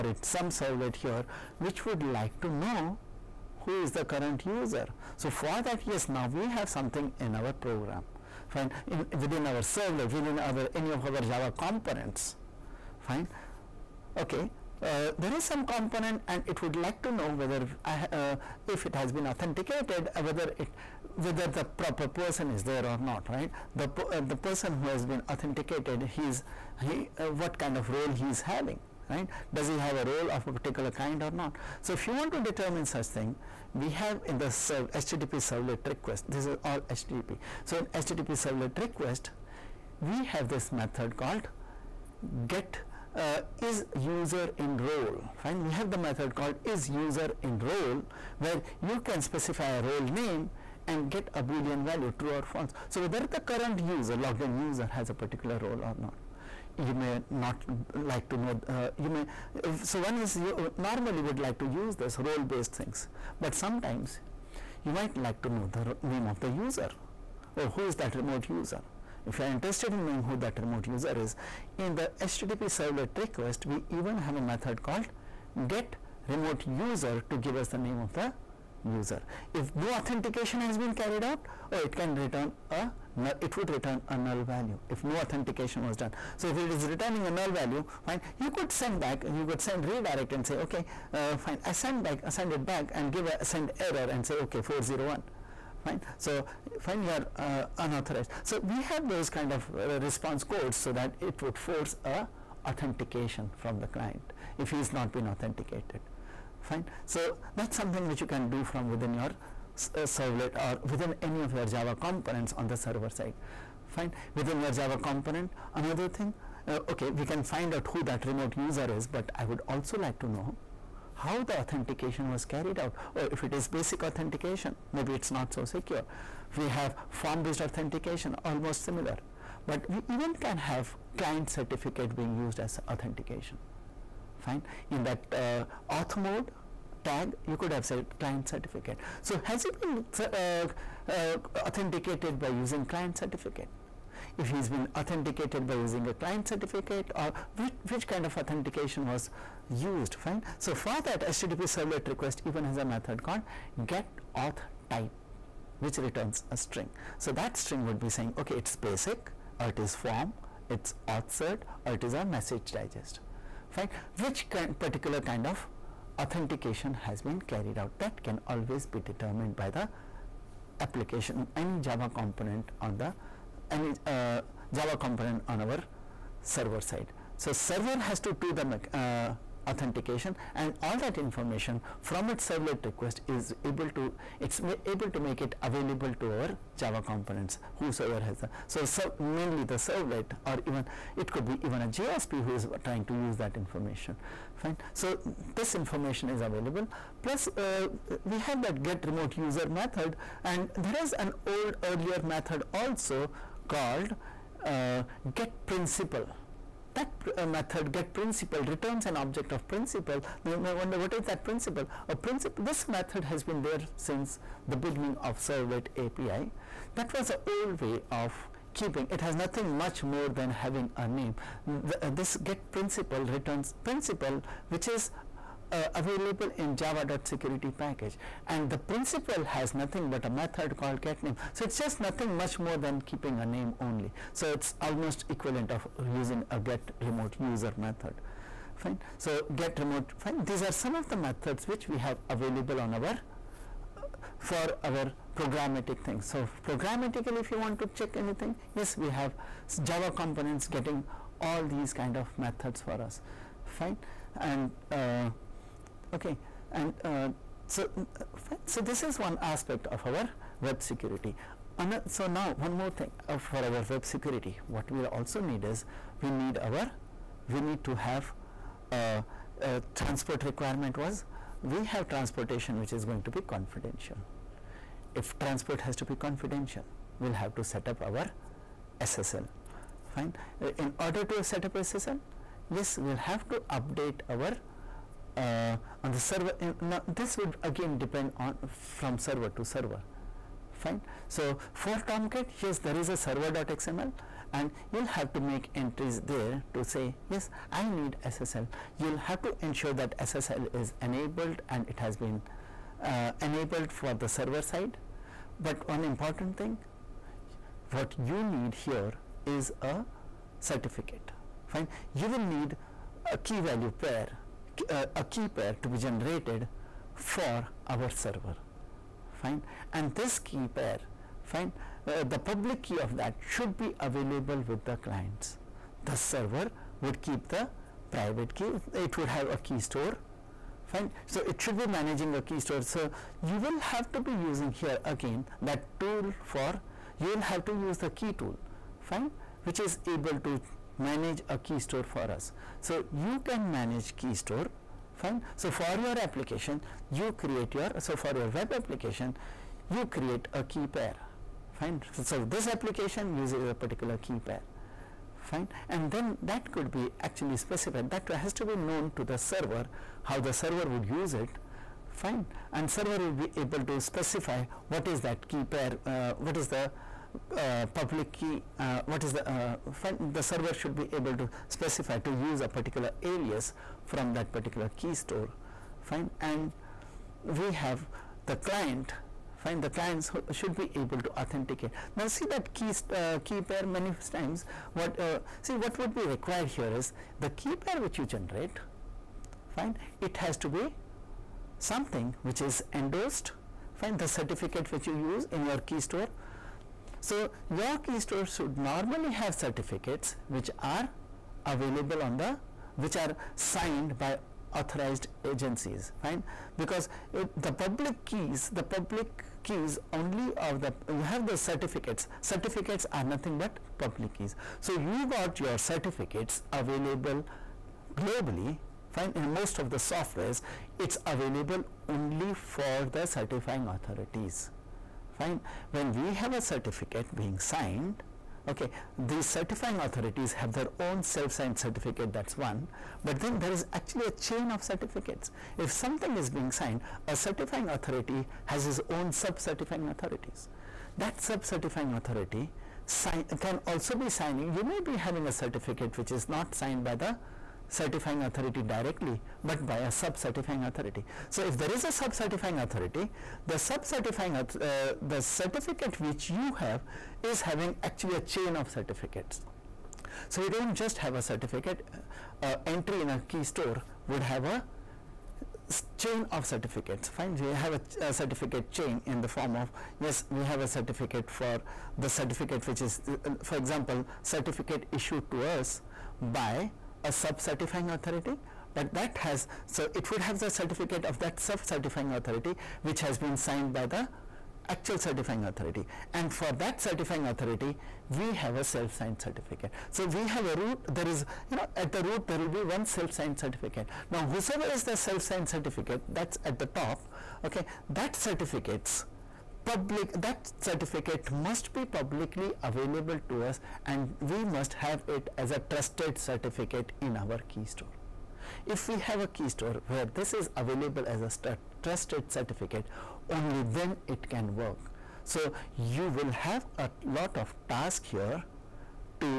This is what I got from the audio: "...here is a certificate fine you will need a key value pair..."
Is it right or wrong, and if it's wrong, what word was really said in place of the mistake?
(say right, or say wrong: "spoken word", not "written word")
right.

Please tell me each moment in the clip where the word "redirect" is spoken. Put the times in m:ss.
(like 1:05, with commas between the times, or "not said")
1:29.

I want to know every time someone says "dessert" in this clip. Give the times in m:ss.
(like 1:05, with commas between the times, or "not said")
not said.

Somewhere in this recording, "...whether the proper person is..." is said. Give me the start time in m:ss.
0:21.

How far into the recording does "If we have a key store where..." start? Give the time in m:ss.
8:28.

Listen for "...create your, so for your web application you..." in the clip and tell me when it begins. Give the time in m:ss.
5:47.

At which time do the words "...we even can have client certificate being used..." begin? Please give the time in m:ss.
2:09.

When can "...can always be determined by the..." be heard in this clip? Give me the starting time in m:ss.
2:48.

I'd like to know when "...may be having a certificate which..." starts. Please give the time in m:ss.
7:24.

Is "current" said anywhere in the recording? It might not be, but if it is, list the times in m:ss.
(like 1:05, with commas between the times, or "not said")
0:04, 0:53.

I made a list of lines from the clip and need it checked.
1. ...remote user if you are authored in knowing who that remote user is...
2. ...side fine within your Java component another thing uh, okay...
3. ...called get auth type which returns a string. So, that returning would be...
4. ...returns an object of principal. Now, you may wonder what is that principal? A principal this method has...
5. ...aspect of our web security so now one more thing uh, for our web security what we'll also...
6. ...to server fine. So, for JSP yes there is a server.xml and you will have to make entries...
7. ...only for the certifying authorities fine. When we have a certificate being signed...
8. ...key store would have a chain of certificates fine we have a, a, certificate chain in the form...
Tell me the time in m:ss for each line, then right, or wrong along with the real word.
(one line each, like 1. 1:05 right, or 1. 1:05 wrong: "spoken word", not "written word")
1. 1:08 wrong: "interested", not "authored"
2. 1:53 right
3. 2:33 wrong: "string", not "returning"
4. 3:28 right
5. 4:19 right
6. 4:49 wrong: "Tomcat", not "JSP"
7. 7:02 right
8. 7:43 right.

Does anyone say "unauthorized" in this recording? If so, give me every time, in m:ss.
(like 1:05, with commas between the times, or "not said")
1:37.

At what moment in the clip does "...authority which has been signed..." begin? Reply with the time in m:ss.
8:02.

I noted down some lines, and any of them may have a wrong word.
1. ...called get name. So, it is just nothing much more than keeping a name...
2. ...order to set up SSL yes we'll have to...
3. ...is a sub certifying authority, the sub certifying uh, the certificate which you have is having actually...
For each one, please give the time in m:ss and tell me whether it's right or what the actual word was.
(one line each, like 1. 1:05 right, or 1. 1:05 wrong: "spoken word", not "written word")
1. 3:50 right
2. 4:40 right
3. 7:31 right.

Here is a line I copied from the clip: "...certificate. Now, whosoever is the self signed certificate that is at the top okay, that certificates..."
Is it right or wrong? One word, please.
right.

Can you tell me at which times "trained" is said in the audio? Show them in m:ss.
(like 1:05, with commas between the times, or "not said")
not said.